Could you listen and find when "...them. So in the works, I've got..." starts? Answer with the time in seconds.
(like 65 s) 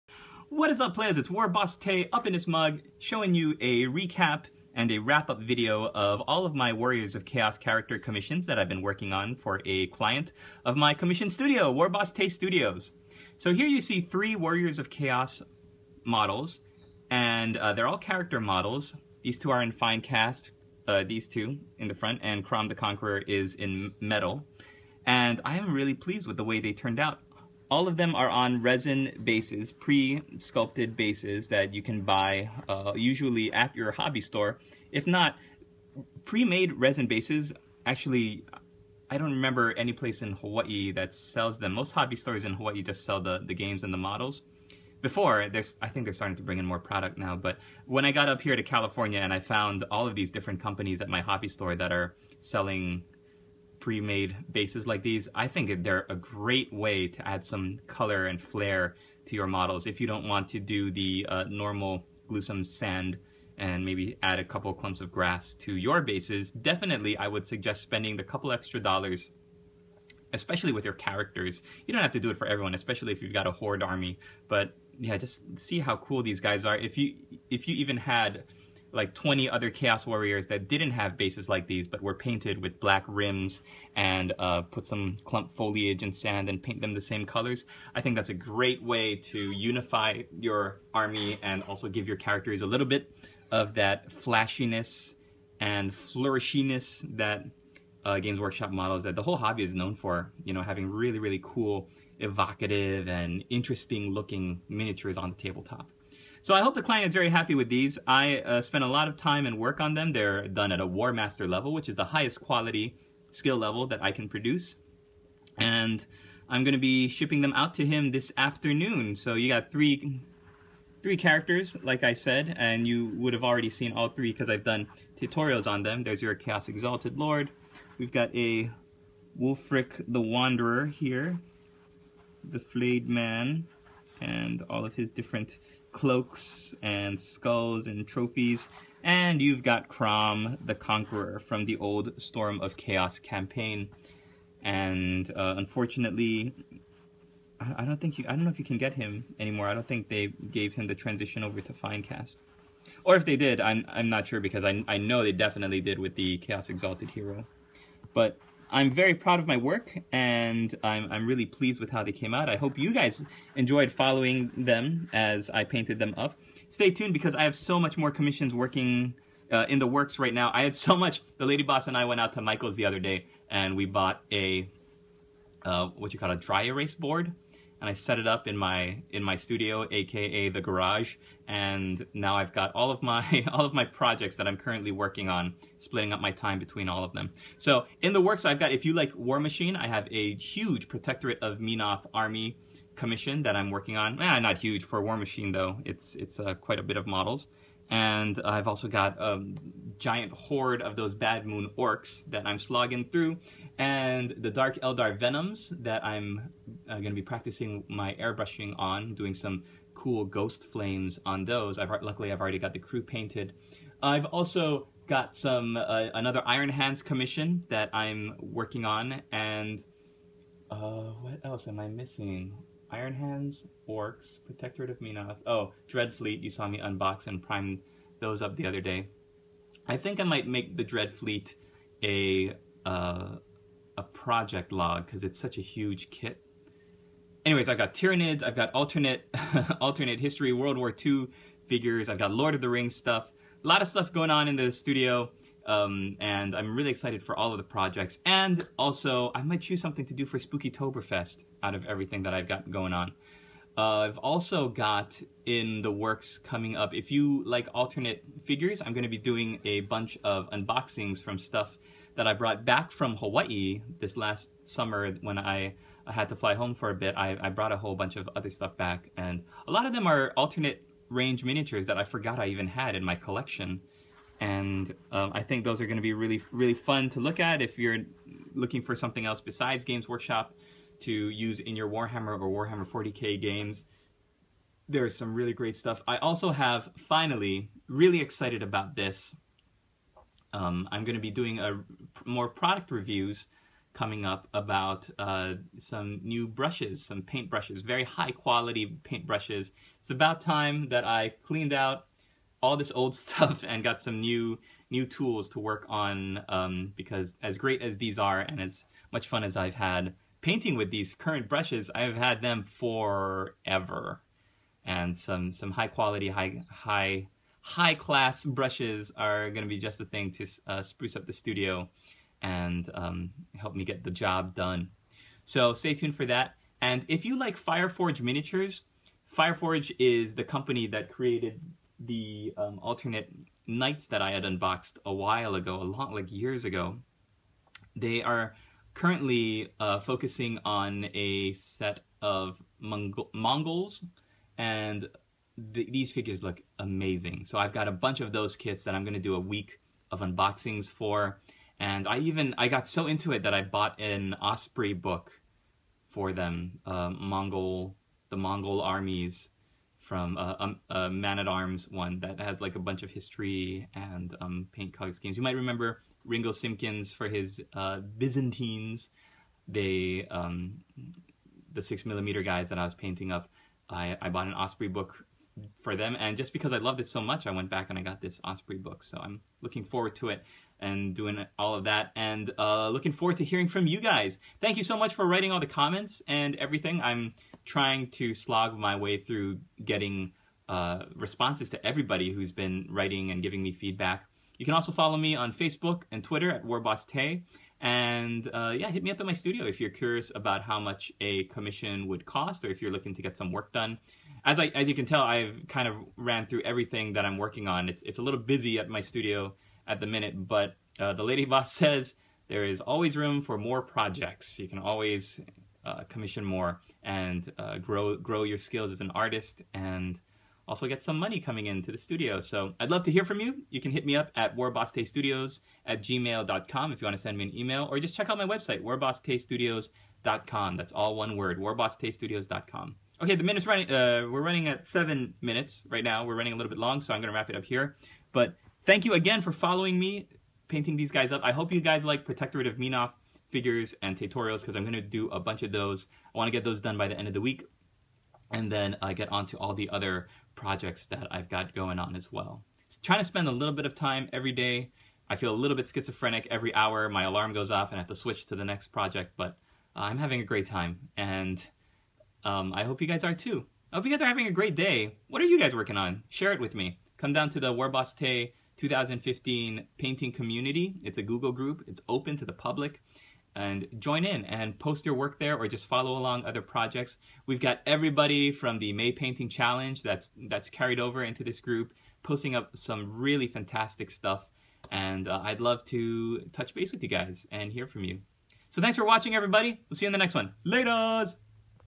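187 s.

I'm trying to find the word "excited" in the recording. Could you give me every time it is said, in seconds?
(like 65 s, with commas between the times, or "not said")
246 s, 288 s.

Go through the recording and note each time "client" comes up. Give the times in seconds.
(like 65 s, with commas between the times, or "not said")
9 s, 106 s.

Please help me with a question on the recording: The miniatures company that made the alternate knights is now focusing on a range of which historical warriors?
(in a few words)
Mongols.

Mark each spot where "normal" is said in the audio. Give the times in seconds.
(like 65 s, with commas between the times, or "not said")
61 s.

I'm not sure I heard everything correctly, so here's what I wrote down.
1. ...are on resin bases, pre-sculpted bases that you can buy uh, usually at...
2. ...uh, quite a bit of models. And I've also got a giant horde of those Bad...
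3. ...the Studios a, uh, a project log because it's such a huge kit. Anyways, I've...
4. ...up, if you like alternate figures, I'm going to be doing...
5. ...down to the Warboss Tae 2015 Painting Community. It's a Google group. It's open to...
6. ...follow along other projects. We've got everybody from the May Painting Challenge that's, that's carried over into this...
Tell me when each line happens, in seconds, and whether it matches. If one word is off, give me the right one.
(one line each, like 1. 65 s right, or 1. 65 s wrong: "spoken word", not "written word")
1. 28 s right
2. 196 s right
3. 230 s wrong: "Dreadfleet", not "Studios"
4. 256 s right
5. 467 s right
6. 475 s right.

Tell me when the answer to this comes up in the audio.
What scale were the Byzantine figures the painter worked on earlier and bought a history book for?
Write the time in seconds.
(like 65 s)
371 s.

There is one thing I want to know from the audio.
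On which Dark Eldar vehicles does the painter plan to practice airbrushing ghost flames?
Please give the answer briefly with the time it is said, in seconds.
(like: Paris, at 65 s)
Venoms, at 205 s.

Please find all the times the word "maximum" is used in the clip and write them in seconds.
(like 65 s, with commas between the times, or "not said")
not said.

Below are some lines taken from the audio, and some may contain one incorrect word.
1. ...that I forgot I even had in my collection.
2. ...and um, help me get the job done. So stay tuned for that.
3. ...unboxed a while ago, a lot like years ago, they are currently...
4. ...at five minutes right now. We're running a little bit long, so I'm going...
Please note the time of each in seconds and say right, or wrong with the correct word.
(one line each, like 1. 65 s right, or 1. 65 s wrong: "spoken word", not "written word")
1. 271 s right
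2. 322 s right
3. 334 s right
4. 434 s wrong: "seven", not "five".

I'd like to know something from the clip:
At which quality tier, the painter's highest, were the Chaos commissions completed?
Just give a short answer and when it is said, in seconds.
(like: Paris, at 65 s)
War Master, at 110 s.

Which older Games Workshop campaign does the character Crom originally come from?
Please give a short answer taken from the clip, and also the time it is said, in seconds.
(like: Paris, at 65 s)
Storm of Chaos, at 142 s.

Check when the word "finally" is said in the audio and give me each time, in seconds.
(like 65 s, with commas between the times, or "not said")
287 s.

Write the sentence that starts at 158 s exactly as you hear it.
But I'm very proud of my work and I'm, I'm really pleased with how they came out.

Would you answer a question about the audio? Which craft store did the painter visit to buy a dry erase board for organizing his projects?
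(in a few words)
Michael's.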